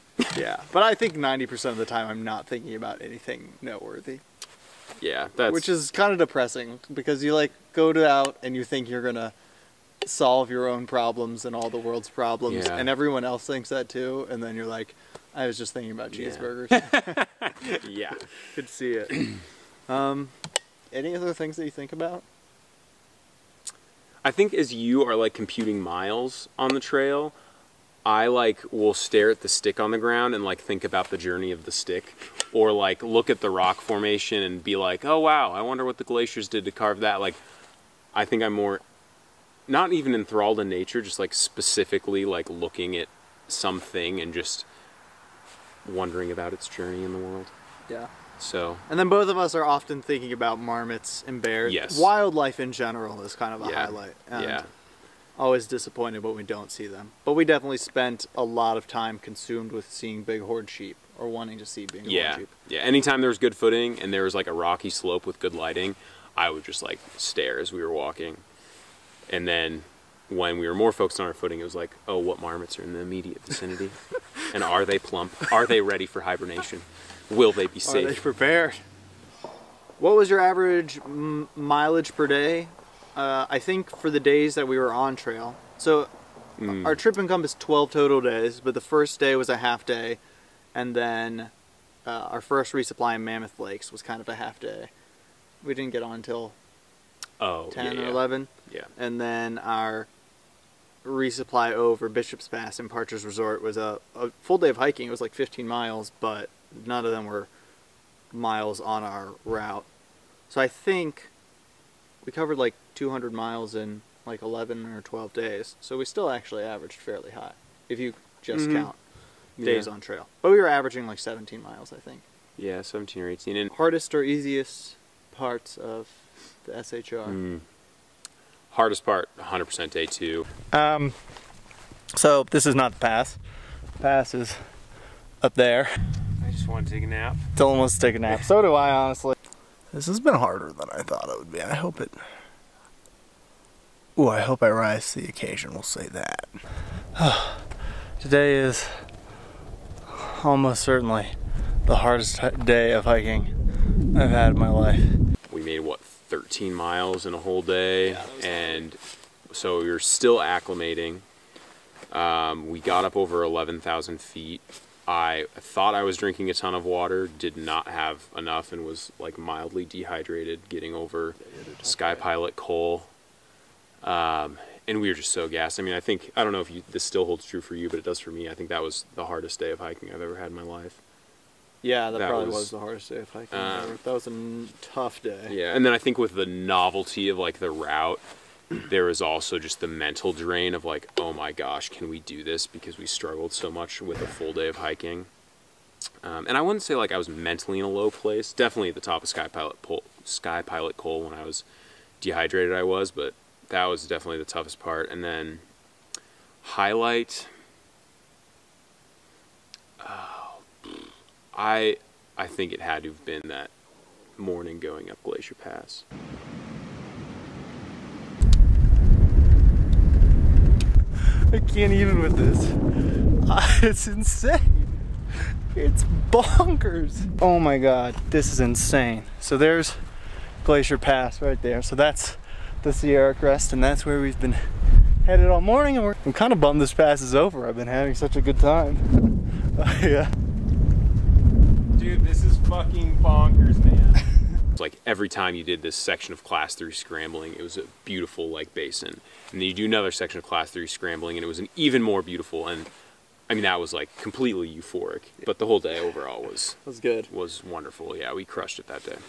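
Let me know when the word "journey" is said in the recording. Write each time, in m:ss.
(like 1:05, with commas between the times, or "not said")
0:31, 0:46.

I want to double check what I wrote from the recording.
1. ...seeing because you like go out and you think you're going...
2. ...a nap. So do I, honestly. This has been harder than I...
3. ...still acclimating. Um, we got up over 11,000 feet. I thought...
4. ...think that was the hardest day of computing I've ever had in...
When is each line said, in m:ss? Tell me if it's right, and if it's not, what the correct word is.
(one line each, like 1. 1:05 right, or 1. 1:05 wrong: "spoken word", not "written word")
1. 0:06 wrong: "depressing", not "seeing"
2. 2:18 right
3. 2:39 right
4. 2:58 wrong: "hiking", not "computing".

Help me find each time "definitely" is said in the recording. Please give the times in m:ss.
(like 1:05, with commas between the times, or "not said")
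0:57, 3:18, 3:24.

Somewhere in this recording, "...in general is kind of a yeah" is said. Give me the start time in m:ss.
0:52.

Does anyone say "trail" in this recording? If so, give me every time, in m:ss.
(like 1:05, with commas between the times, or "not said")
0:26, 1:25, 2:00.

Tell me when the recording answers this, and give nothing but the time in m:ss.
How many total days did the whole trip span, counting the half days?
1:27.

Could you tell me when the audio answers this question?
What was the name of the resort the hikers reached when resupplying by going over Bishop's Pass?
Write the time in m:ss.
1:42.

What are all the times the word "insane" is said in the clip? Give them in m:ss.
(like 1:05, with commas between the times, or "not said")
3:44, 3:48.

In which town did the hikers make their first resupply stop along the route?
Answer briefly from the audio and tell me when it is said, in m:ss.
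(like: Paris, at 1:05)
Mammoth Lakes, at 1:33.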